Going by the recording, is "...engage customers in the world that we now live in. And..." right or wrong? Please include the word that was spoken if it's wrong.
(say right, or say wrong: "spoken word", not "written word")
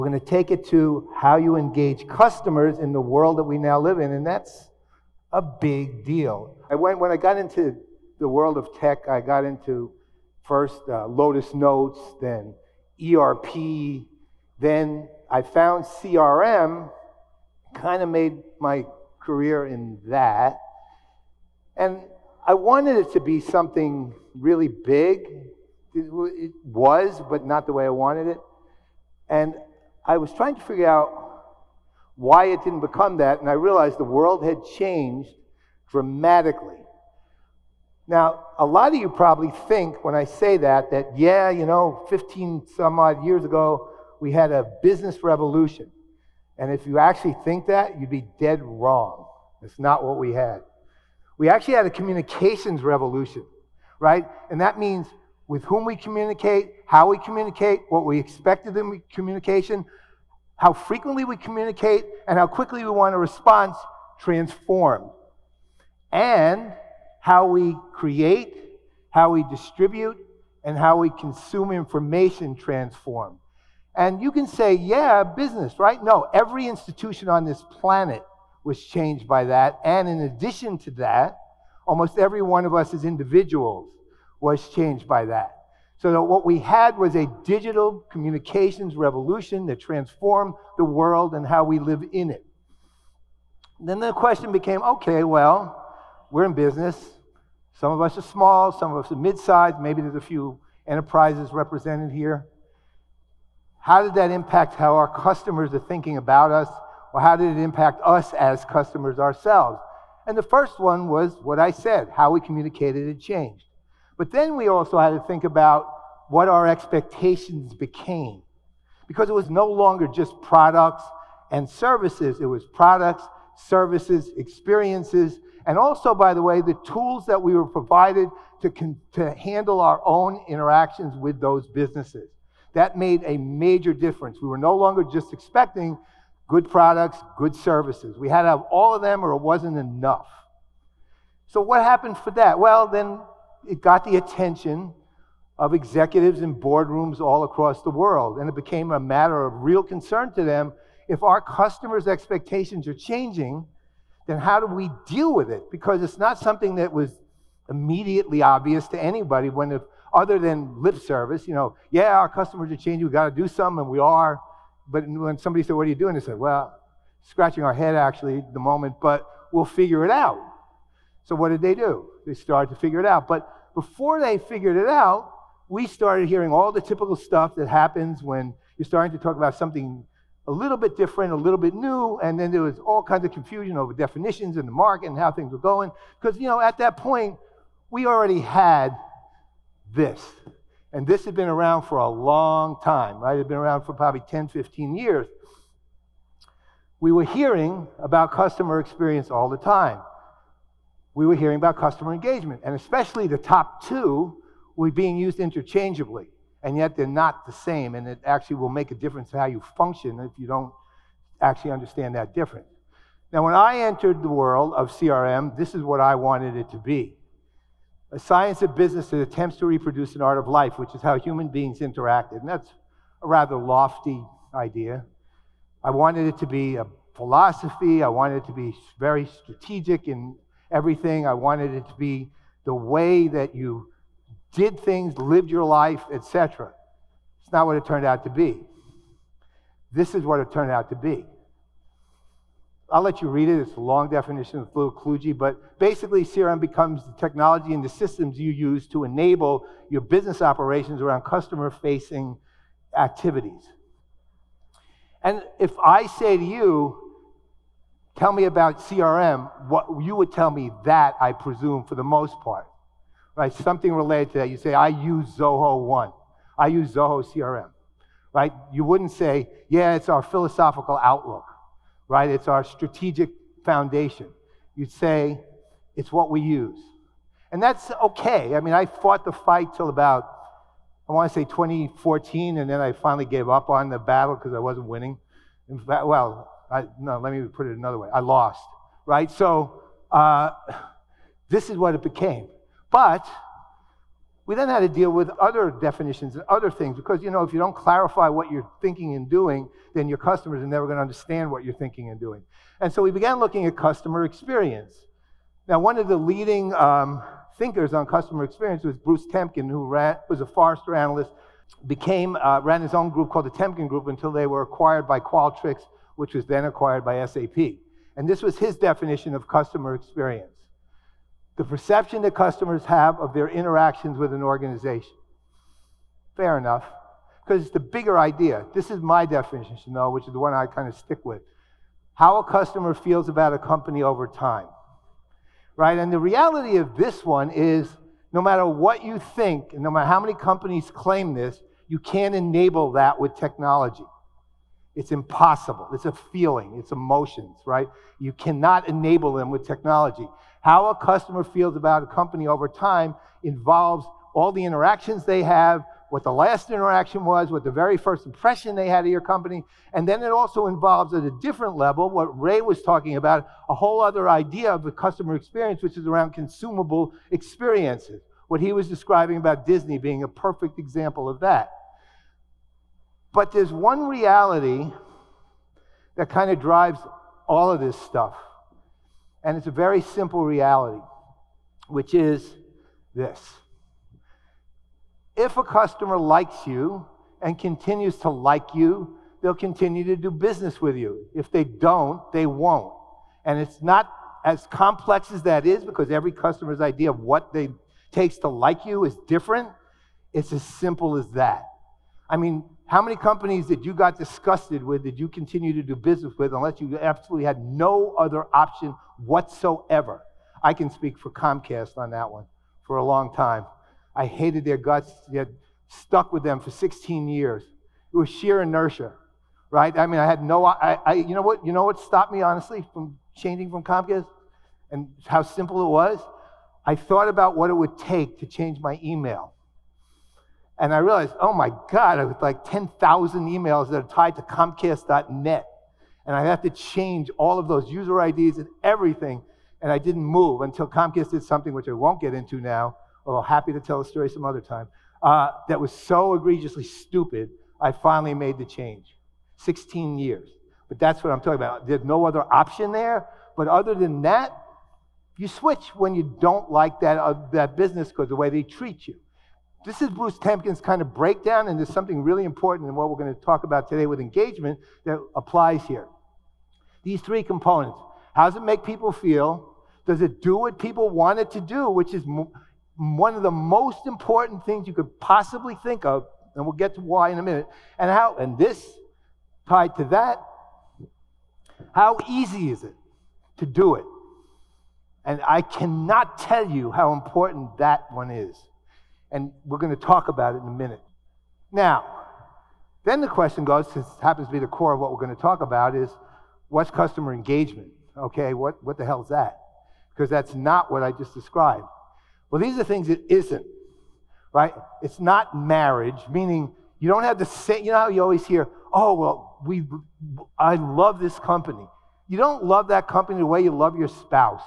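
right.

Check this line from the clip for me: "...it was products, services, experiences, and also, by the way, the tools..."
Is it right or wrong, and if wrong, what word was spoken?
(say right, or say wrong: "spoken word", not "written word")
right.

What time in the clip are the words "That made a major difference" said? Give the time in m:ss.
2:12.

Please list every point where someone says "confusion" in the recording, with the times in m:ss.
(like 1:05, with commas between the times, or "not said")
3:03.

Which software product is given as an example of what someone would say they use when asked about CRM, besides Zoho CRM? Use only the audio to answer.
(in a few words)
Zoho One.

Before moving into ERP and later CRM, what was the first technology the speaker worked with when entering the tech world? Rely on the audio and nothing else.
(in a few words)
Lotus Notes.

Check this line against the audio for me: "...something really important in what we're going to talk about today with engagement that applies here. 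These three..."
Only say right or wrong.
right.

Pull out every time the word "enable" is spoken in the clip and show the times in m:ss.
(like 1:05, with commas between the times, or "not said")
4:09, 5:42, 5:48.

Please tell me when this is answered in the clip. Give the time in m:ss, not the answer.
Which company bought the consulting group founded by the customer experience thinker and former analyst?
5:15.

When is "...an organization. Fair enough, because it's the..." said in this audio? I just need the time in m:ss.
5:24.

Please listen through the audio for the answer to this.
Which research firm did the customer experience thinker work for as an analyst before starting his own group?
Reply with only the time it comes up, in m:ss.
5:10.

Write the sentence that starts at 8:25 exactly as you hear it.
It's not marriage, meaning you don't have the same, you know how you always hear, oh, well, we, I love this company.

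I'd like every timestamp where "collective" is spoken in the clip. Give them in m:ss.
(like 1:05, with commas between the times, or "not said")
not said.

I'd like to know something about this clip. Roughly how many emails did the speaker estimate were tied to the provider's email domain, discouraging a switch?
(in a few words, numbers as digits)
10,000.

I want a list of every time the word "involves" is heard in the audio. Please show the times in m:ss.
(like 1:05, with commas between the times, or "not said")
5:53, 6:00.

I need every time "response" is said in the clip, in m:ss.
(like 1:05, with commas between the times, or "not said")
1:03.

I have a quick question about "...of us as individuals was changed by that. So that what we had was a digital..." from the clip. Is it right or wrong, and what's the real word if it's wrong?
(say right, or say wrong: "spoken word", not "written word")
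right.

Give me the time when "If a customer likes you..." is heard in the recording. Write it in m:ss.
6:25.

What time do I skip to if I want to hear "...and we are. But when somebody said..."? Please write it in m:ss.
2:43.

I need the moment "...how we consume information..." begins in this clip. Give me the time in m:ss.
1:10.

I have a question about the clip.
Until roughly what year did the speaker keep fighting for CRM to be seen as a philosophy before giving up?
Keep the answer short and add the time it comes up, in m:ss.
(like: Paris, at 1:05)
2014, at 4:41.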